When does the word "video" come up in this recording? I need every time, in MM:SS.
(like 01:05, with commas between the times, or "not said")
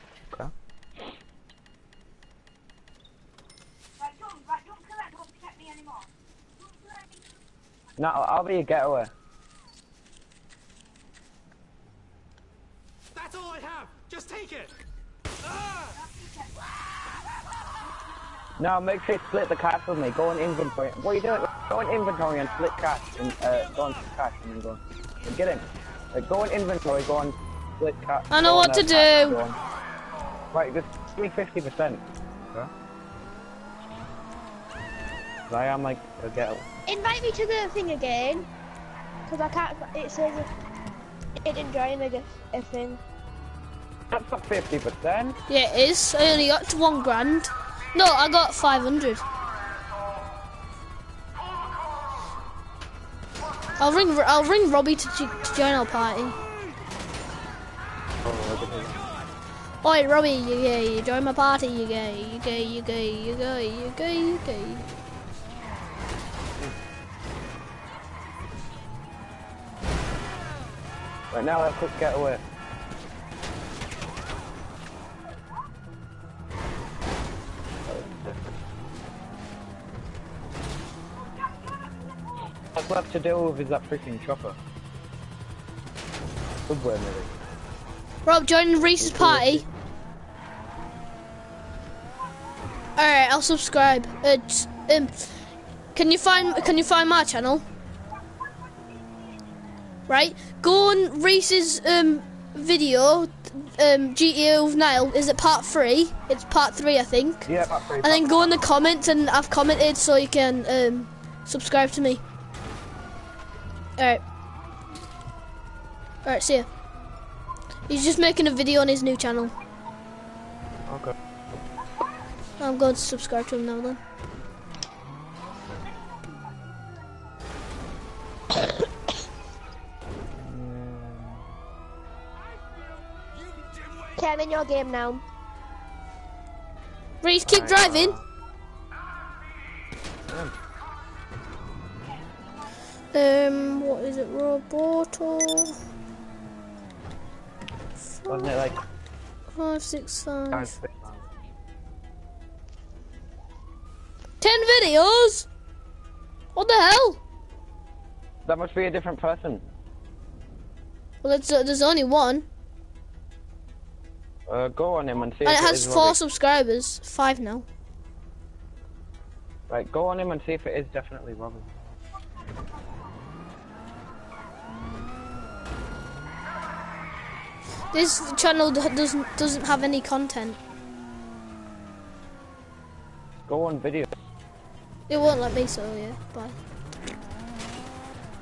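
01:42, 01:58, 02:34, 03:03.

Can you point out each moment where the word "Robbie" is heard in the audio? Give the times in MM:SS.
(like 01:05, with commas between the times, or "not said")
00:54, 01:00, 02:46.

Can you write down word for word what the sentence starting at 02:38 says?
That must be a different person.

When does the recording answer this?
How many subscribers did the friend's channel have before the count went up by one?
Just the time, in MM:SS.
02:45.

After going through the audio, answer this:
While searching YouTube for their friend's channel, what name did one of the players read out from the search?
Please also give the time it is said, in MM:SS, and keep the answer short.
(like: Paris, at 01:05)
Roboto, at 02:24.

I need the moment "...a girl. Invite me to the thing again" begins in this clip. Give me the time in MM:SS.
00:36.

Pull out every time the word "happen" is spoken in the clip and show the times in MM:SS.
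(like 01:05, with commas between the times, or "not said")
not said.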